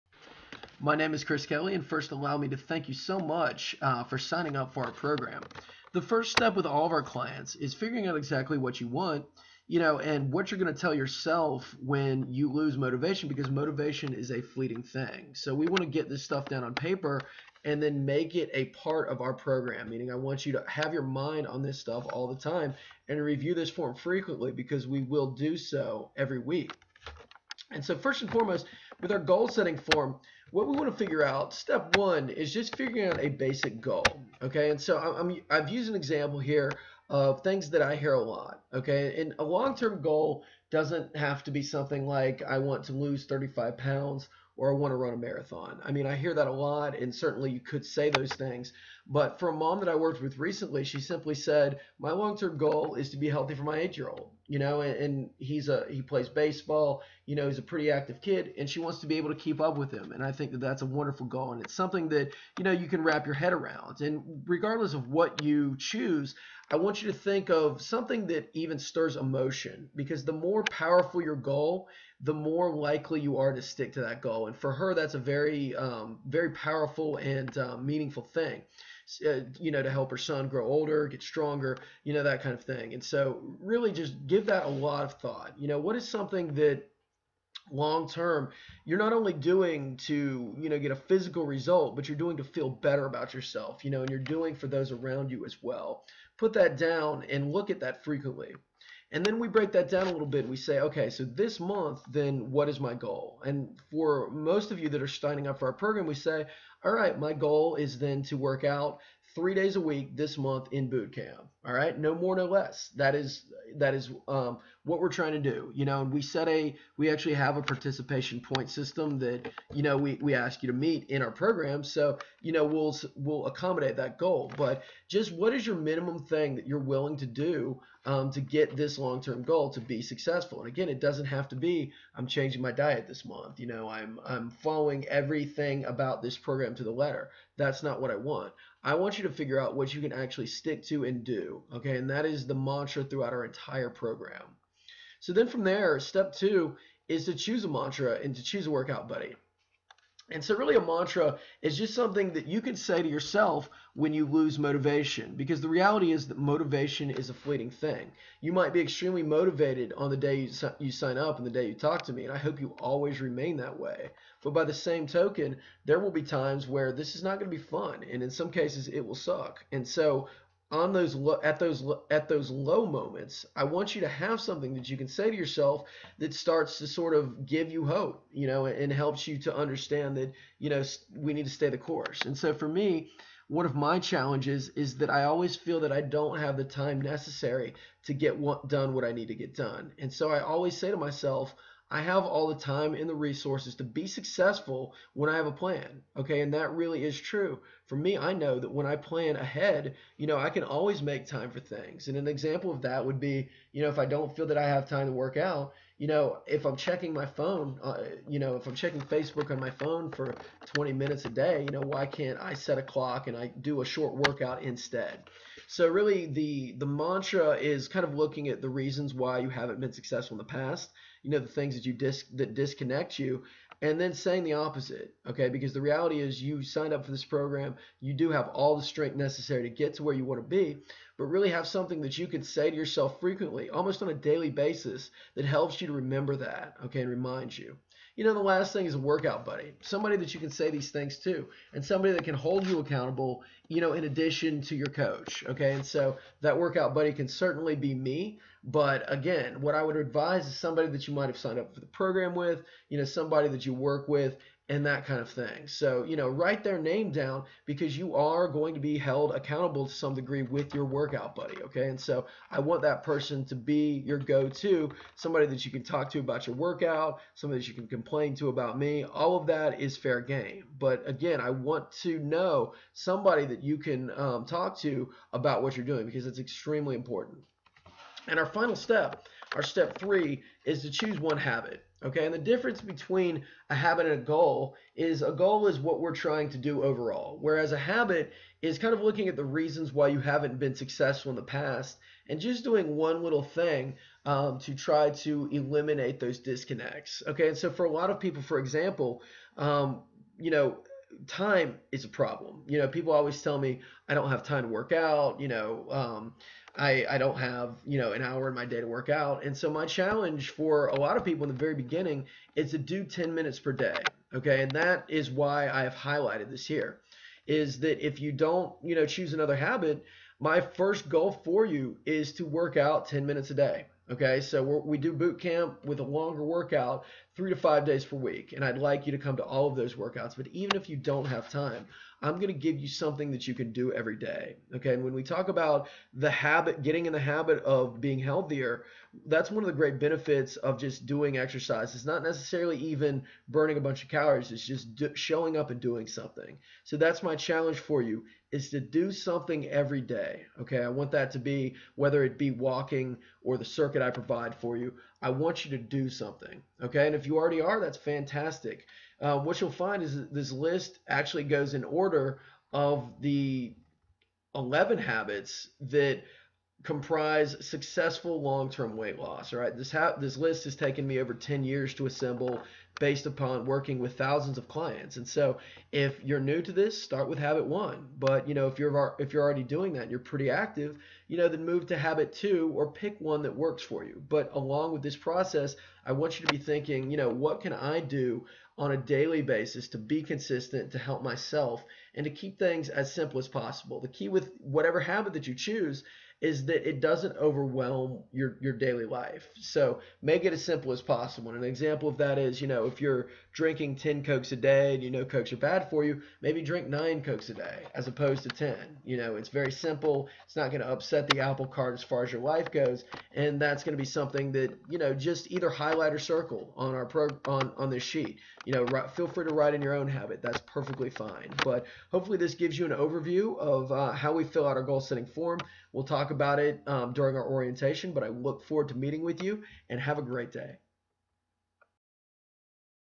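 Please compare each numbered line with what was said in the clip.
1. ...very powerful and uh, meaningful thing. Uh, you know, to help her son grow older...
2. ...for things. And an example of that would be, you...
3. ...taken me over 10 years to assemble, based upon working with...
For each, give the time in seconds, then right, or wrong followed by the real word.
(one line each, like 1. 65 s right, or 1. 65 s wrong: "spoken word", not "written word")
1. 76 s right
2. 201 s right
3. 370 s right.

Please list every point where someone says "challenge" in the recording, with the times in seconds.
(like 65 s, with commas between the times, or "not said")
183 s, 309 s, 347 s.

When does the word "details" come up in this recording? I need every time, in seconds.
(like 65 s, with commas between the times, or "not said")
not said.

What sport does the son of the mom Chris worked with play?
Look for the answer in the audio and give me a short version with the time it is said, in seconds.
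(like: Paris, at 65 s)
Baseball, at 56 s.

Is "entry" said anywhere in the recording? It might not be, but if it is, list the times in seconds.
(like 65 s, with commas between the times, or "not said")
not said.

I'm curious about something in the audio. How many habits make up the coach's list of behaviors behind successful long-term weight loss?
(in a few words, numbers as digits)
11.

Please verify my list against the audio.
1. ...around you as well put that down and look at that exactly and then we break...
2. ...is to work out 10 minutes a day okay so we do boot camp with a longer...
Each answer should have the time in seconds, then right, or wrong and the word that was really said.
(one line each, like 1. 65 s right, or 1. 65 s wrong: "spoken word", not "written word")
1. 94 s wrong: "frequently", not "exactly"
2. 322 s right.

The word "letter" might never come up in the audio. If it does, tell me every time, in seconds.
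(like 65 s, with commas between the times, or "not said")
136 s.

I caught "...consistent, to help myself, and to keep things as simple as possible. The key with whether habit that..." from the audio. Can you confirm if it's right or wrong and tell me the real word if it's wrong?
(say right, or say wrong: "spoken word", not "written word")
wrong: "whatever", not "whether".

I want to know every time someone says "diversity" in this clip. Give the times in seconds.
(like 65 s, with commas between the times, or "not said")
not said.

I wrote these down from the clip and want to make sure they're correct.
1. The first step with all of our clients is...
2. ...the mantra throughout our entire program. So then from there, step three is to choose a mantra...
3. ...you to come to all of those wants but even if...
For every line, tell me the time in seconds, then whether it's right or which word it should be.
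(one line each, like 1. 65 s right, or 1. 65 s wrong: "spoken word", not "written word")
1. 5 s right
2. 142 s wrong: "two", not "three"
3. 329 s wrong: "workouts", not "wants".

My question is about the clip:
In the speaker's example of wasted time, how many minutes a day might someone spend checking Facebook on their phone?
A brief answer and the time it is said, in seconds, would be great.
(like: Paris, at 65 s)
20, at 210 s.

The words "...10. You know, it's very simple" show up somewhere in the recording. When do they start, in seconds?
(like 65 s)
408 s.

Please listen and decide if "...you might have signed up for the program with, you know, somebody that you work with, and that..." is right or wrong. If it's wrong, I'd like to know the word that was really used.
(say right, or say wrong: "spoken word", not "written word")
right.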